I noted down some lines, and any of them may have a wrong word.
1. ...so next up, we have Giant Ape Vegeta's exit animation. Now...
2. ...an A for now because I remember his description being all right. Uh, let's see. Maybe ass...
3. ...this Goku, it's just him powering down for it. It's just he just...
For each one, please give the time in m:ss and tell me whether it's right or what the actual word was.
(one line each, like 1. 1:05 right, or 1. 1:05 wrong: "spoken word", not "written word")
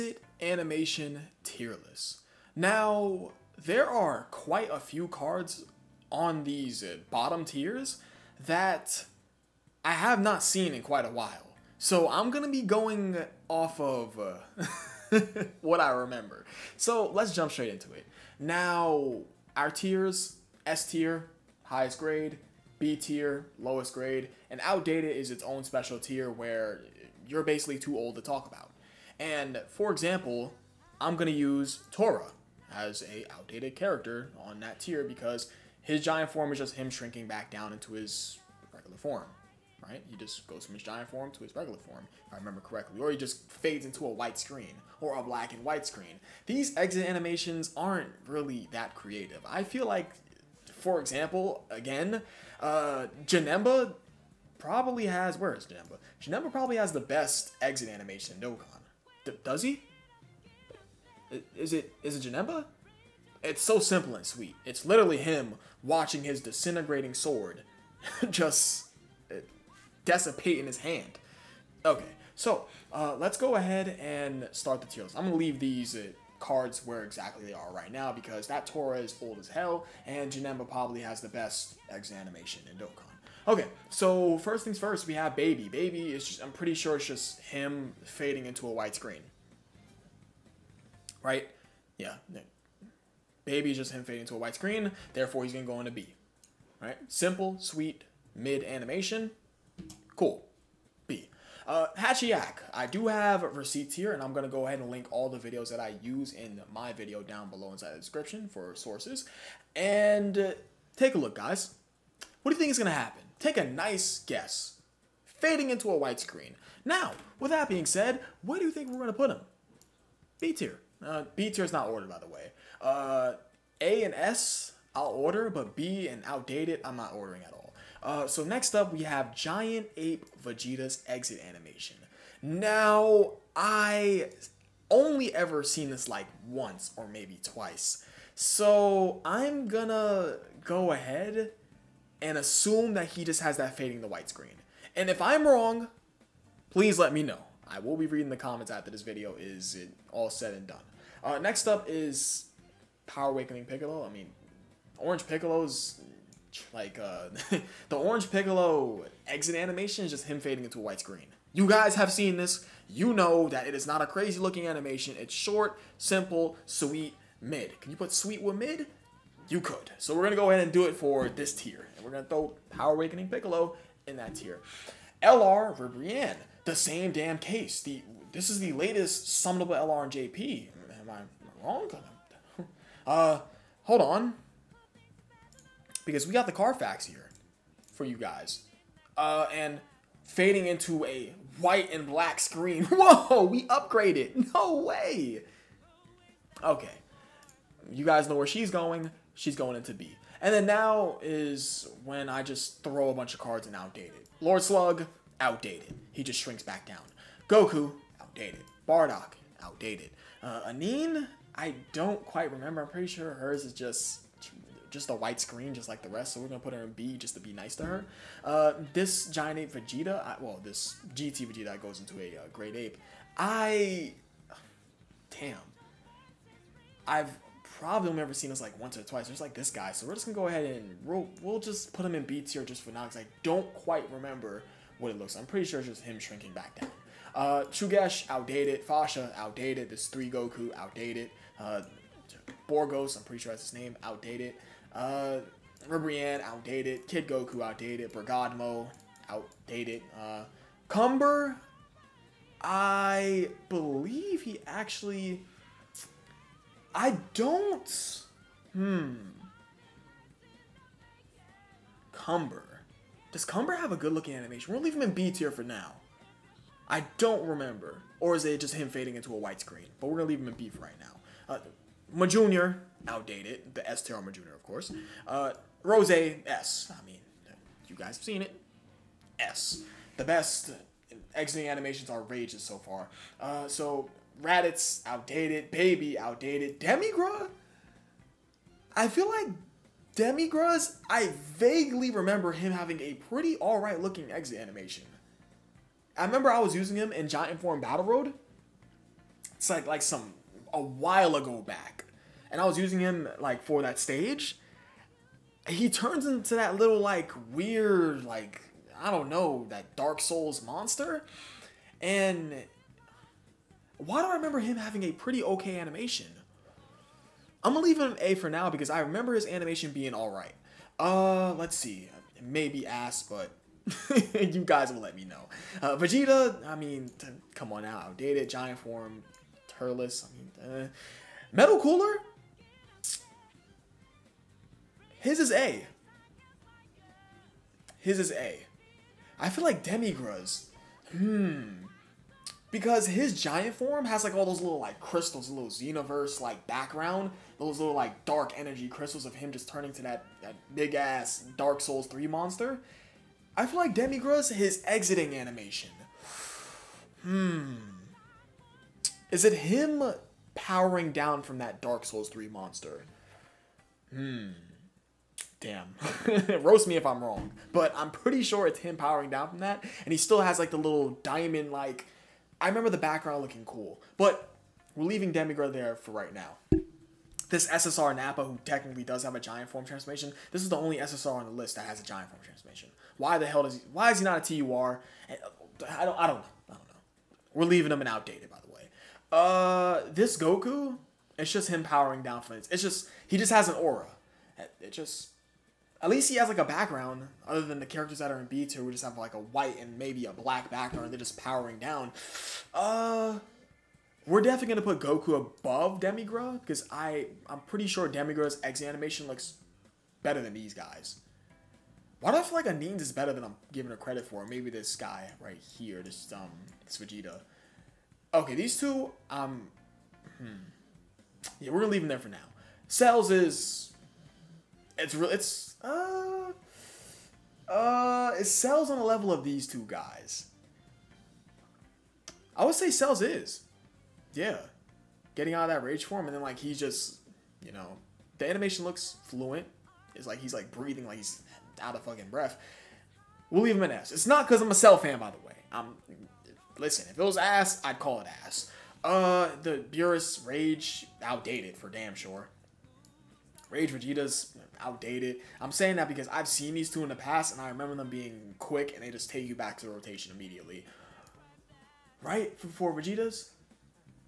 1. 2:08 right
2. 5:18 wrong: "animation", not "description"
3. 6:30 right.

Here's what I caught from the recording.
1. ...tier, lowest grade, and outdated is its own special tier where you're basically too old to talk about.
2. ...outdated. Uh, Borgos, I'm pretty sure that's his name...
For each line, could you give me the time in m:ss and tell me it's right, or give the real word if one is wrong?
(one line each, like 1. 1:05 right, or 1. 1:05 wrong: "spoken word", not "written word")
1. 0:22 right
2. 4:00 right.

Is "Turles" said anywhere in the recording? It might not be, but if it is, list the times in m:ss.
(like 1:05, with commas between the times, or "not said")
5:29.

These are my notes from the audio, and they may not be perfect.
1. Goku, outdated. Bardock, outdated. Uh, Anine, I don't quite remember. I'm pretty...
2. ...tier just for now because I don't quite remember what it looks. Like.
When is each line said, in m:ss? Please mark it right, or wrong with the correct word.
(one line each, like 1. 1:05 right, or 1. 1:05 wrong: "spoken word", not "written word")
1. 3:27 right
2. 3:52 right.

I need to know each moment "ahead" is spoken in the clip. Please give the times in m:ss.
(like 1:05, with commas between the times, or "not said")
1:13, 1:44, 2:20, 2:50, 3:50.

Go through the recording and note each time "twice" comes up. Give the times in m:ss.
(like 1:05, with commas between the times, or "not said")
2:17, 3:49.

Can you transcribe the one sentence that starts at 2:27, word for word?
I will be reading the comments after this video is all said and done.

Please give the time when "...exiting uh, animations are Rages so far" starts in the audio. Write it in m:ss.
4:41.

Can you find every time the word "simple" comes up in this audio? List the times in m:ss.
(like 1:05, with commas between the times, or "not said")
1:03, 1:37, 2:45.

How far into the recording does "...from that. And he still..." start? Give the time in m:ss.
6:09.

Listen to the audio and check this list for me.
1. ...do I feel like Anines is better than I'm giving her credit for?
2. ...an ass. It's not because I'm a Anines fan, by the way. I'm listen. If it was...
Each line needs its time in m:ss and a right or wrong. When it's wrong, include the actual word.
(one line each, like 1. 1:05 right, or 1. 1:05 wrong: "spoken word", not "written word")
1. 6:52 right
2. 7:23 wrong: "Cell", not "Anines".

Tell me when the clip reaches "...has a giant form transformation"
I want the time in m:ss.
6:21.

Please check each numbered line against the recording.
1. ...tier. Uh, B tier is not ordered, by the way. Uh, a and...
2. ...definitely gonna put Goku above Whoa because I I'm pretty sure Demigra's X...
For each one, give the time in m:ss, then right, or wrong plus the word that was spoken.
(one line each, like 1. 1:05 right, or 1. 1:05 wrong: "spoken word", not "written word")
1. 2:00 right
2. 6:44 wrong: "Demigra", not "Whoa".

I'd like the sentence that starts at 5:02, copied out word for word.
And I was using him like for that stage.